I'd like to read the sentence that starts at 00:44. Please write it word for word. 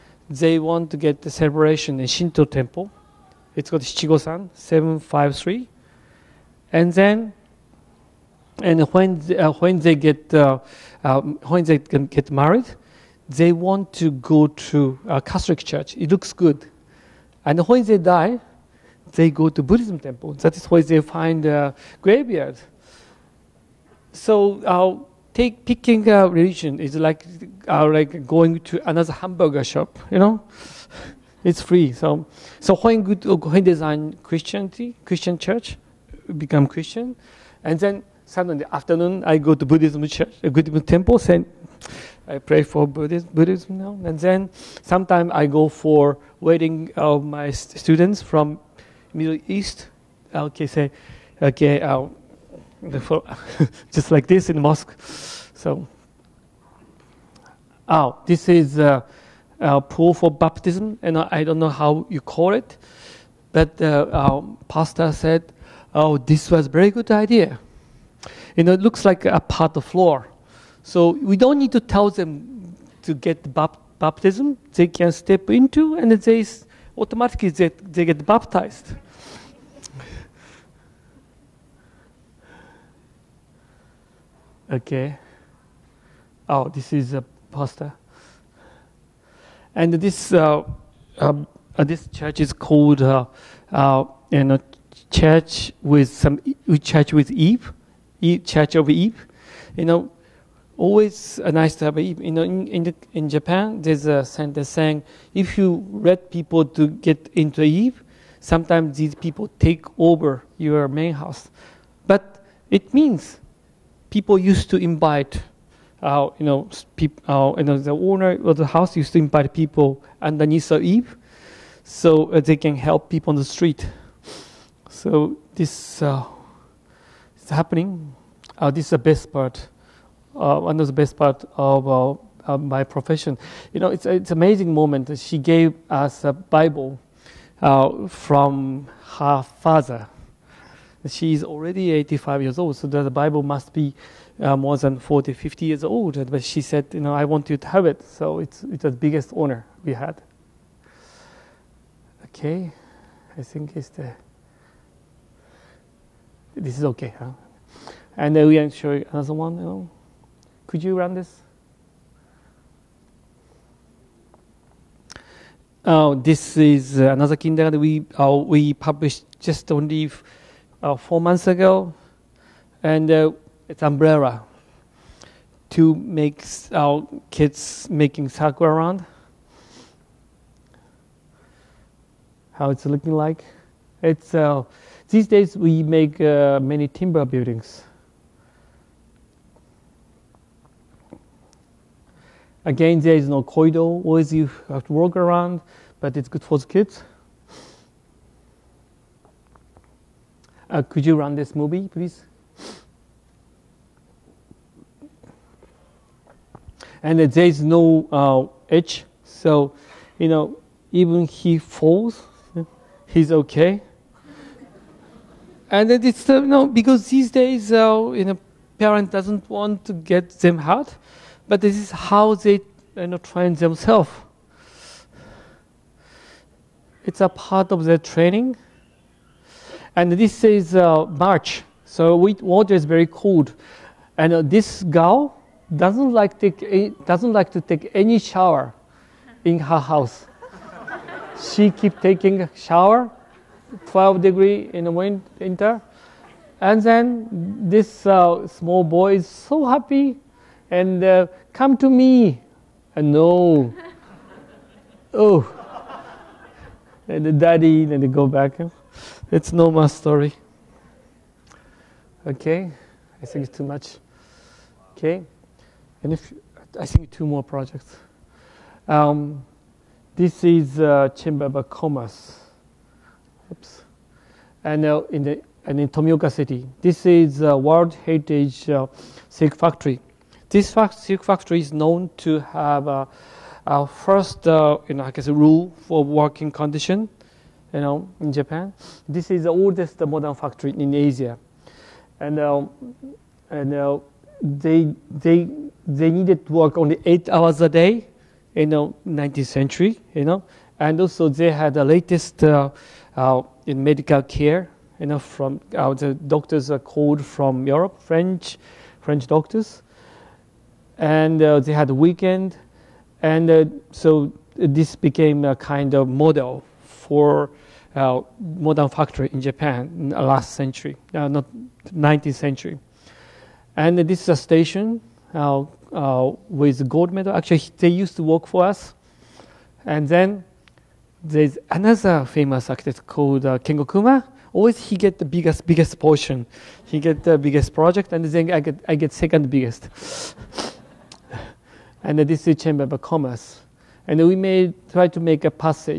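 And then sometimes I go for wedding of my students from Middle East.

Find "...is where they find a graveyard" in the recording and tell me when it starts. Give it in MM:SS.
00:20.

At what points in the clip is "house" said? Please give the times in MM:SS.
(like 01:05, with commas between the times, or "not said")
01:51, 01:58, 03:59.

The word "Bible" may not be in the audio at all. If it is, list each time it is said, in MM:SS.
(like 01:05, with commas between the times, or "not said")
02:16, 02:23.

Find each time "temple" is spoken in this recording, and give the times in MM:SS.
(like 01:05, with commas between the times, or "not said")
00:02, 00:19, 00:40.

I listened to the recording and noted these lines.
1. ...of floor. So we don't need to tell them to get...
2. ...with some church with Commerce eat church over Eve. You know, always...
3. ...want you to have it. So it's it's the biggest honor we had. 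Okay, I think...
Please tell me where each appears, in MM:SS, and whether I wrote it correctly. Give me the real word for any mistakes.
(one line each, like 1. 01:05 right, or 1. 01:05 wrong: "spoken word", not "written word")
1. 01:09 right
2. 01:35 wrong: "Eve", not "Commerce"
3. 02:27 right.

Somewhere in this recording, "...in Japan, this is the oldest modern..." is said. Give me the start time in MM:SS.
04:48.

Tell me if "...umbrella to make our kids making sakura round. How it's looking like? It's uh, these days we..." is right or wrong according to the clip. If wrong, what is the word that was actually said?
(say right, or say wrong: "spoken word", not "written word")
right.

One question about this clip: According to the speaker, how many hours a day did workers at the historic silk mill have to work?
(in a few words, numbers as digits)
8.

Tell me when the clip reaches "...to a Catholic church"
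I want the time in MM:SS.
00:14.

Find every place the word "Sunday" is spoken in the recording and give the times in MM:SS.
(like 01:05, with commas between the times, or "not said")
00:38.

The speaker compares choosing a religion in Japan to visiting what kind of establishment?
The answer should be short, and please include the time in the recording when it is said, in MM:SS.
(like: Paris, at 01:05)
hamburger shop, at 00:29.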